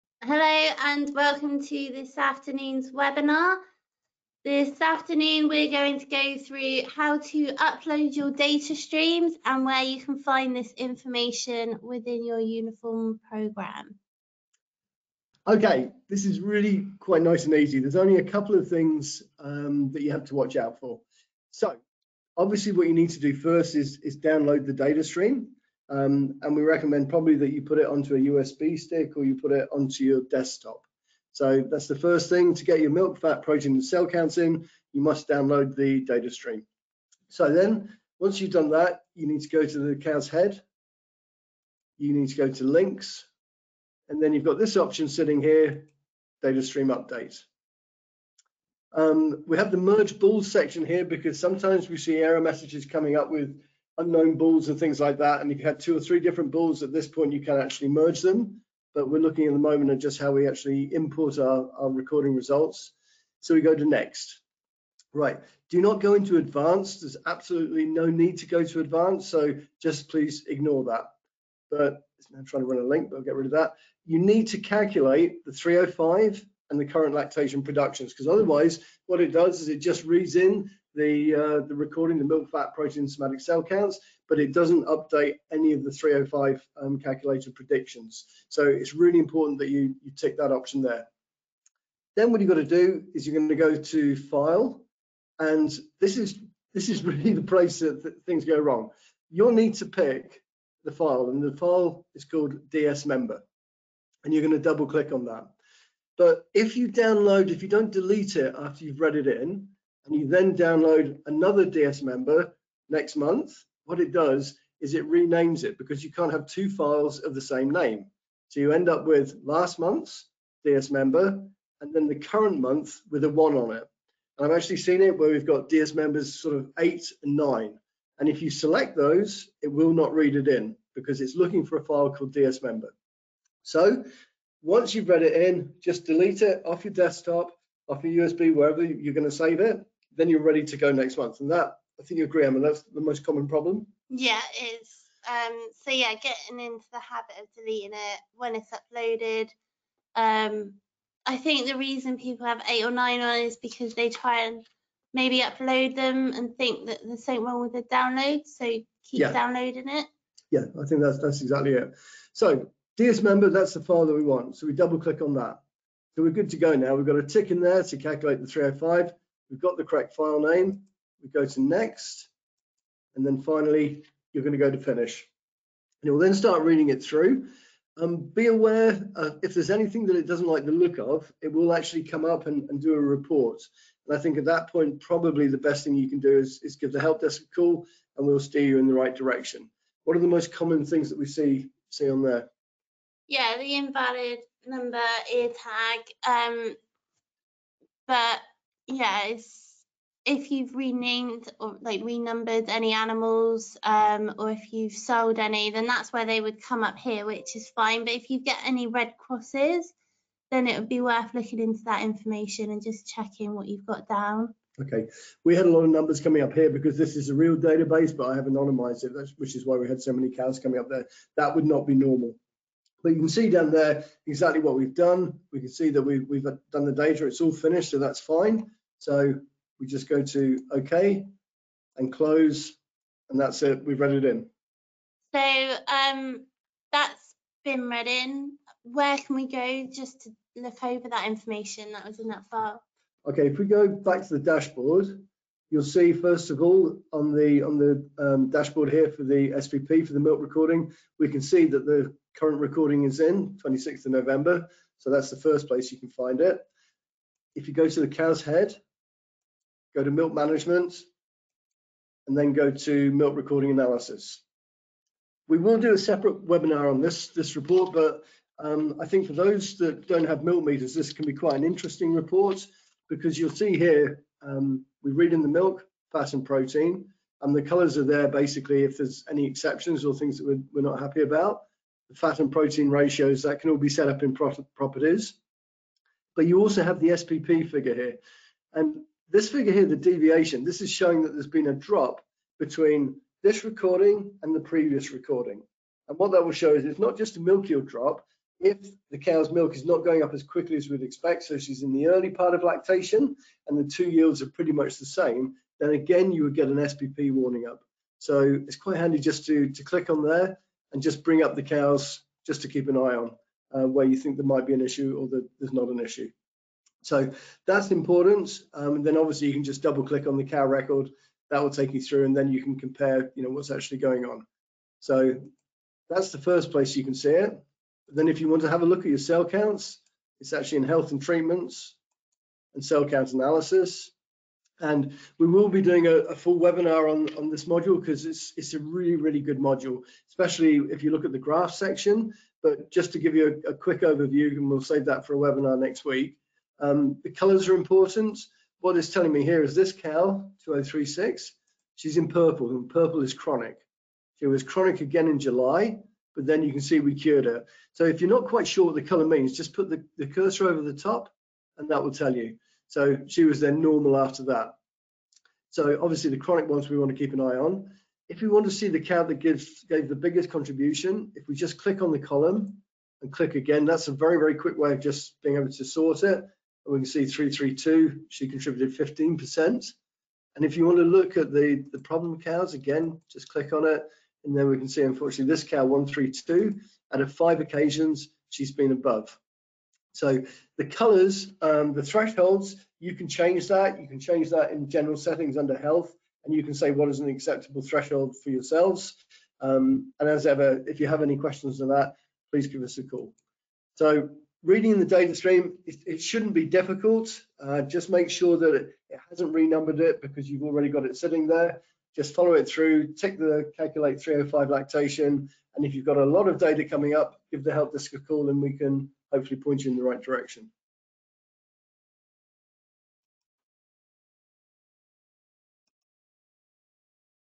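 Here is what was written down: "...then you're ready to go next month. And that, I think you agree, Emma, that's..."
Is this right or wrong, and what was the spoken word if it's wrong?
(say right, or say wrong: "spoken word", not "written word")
right.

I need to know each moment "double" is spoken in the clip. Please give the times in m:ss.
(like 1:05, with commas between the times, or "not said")
1:44, 2:44, 5:19.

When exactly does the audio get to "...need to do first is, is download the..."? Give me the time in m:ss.
0:22.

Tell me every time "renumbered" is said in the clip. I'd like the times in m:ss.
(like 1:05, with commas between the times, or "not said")
3:22, 6:49.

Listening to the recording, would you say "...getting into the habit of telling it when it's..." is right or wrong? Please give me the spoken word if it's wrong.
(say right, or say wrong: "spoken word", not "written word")
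wrong: "deleting", not "telling".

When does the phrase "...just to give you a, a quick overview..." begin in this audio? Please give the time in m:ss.
5:42.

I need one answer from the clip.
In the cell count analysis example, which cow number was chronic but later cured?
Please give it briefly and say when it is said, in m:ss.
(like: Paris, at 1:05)
2036, at 5:50.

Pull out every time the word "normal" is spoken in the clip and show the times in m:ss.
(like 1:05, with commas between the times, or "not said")
3:41, 6:03.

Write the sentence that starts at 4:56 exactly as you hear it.
And what that will show is it's not just a milk yield drop.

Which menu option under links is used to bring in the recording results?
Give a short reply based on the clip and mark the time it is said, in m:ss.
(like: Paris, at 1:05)
Data stream update, at 0:46.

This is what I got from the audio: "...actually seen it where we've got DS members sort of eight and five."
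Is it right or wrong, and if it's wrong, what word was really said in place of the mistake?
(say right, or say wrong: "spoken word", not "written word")
wrong: "nine", not "five".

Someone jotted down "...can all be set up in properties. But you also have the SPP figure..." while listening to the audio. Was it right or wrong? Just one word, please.
right.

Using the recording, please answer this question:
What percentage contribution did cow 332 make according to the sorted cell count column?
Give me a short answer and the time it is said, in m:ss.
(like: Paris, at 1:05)
15%, at 6:18.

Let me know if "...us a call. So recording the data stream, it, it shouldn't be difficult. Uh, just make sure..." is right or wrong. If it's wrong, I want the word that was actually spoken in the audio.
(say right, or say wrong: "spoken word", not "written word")
wrong: "reading", not "recording".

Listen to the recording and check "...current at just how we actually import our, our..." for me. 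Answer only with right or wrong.
wrong.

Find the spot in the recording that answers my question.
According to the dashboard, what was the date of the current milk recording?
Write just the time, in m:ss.
4:13.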